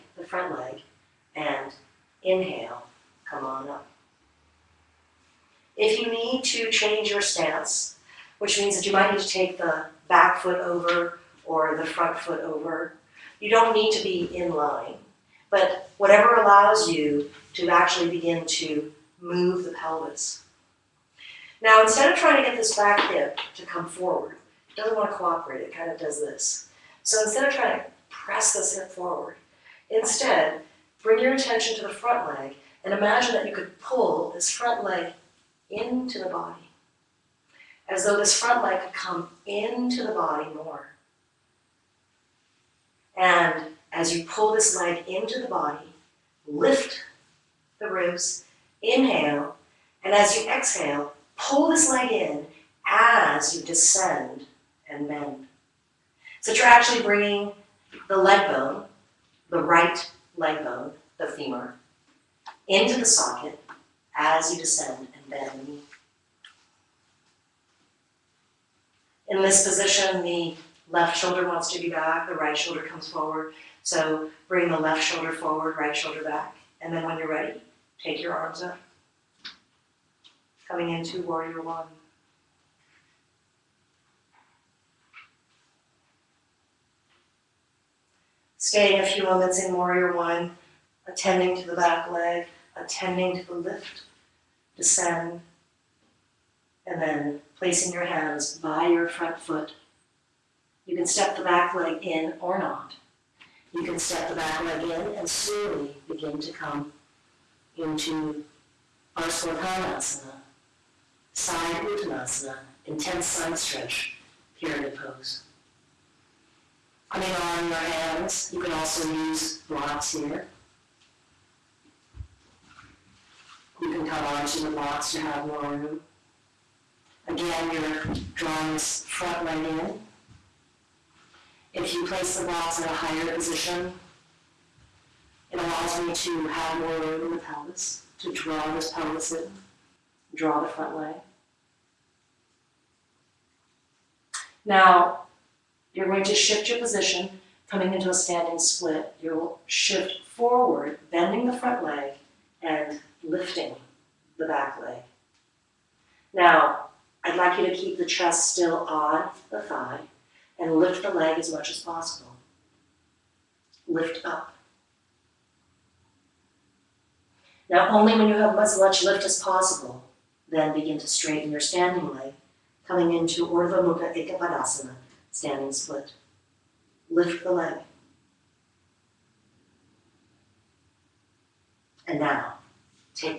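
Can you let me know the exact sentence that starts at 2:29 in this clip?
You'll shift forward, bending the front leg and lifting the back leg.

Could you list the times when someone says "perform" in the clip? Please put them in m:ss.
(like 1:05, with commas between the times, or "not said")
not said.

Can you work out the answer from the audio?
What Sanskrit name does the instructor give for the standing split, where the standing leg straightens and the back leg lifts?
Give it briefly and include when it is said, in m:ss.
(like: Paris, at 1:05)
Urdhva Mukha Ekapadasana, at 2:53.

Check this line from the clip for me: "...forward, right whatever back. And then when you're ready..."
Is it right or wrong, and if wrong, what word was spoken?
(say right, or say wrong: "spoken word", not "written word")
wrong: "shoulder", not "whatever".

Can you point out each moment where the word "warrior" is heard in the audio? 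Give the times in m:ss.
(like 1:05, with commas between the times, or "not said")
1:21, 1:29.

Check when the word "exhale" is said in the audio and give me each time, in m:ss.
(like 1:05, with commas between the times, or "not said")
0:50.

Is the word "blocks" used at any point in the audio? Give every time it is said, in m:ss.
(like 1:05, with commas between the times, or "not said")
1:59, 2:04, 2:12.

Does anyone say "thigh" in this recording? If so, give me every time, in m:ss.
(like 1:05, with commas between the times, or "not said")
2:39.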